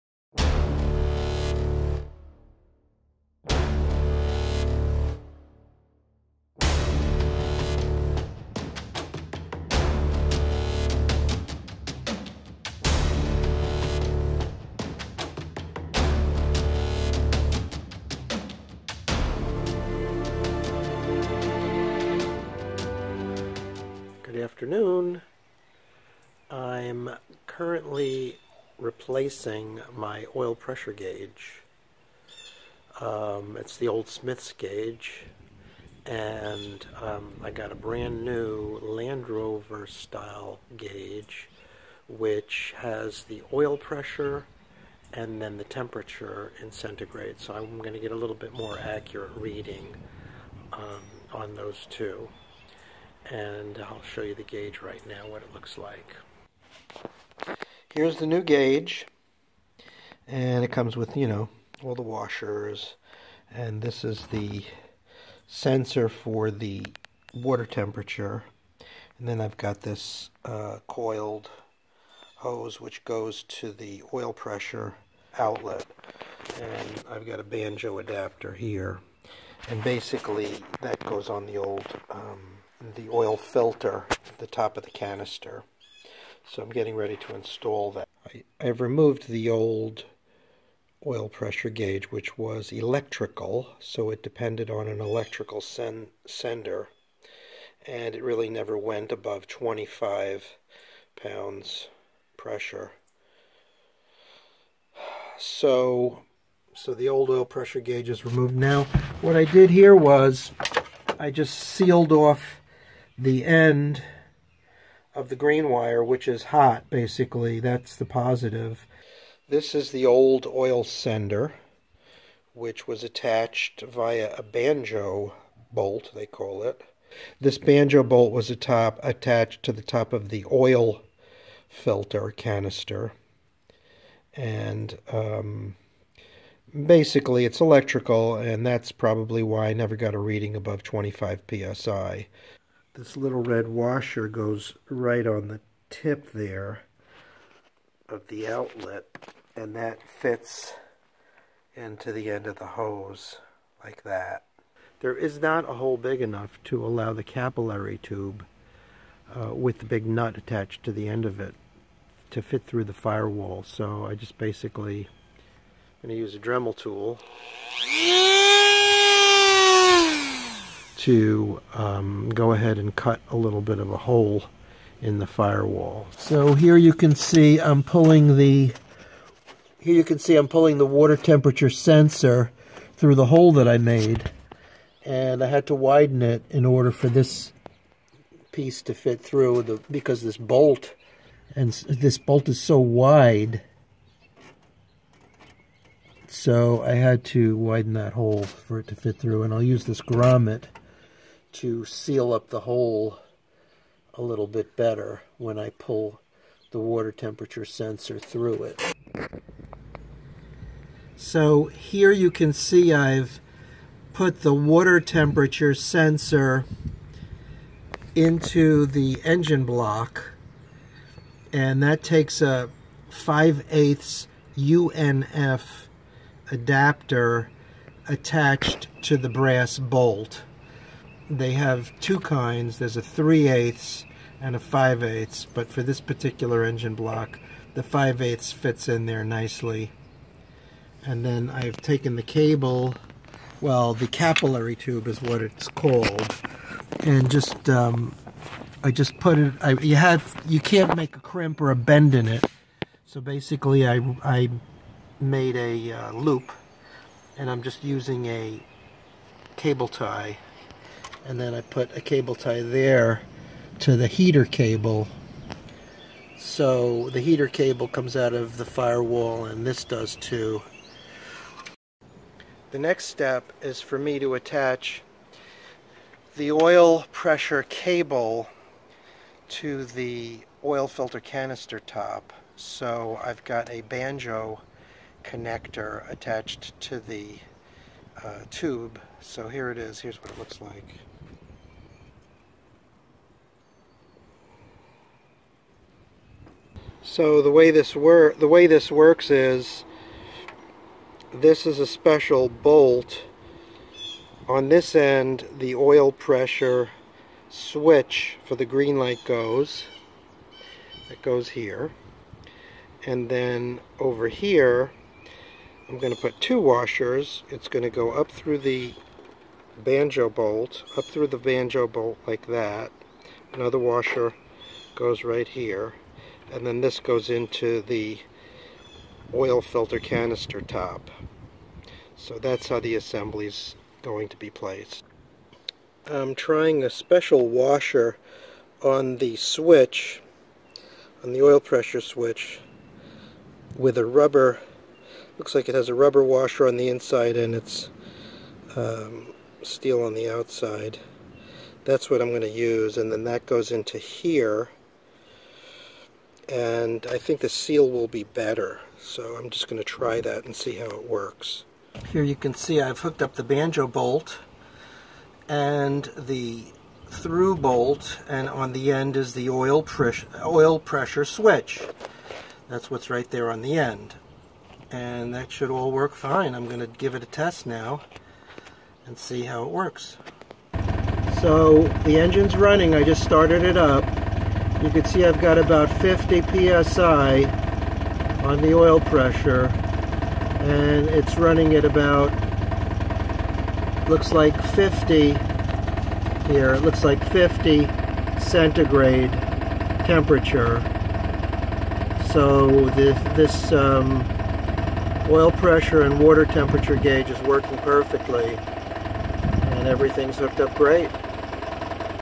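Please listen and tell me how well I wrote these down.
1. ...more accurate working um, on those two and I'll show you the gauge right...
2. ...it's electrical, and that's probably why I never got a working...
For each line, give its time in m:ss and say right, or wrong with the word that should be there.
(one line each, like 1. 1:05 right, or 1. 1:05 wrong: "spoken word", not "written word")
1. 0:48 wrong: "reading", not "working"
2. 2:17 wrong: "reading", not "working".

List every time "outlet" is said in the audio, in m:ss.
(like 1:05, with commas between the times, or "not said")
1:15, 2:28.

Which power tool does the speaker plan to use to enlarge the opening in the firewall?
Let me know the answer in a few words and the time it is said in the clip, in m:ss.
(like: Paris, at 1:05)
Dremel, at 2:46.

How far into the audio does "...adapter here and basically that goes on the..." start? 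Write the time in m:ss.
1:17.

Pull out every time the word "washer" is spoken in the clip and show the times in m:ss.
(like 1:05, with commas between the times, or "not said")
1:02, 2:23, 5:16, 5:23, 5:37, 5:46.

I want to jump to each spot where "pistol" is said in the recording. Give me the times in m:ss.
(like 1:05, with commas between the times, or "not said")
not said.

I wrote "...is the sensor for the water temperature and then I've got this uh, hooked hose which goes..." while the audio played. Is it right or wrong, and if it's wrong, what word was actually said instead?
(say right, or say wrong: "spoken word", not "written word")
wrong: "coiled", not "hooked".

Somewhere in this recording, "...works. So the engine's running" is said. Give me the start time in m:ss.
6:19.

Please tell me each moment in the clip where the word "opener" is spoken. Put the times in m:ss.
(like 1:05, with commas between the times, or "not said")
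not said.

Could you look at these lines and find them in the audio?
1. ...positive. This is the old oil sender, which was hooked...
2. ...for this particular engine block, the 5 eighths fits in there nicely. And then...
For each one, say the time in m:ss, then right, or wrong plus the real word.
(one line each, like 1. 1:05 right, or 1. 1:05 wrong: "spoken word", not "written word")
1. 1:58 wrong: "attached", not "hooked"
2. 3:55 right.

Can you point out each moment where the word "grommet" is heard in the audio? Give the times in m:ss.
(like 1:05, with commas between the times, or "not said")
3:20.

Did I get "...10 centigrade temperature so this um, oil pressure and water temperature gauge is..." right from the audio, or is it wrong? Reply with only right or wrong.
wrong.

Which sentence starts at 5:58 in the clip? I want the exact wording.
So I'm just going to try that and see how it works.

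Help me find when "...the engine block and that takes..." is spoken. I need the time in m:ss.
3:38.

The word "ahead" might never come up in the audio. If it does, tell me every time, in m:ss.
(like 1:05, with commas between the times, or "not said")
2:52.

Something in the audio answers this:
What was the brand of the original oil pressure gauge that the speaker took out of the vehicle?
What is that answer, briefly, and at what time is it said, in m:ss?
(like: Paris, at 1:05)
Smith's, at 0:34.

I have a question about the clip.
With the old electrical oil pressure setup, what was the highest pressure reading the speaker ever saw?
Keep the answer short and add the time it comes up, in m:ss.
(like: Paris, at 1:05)
25 psi, at 1:39.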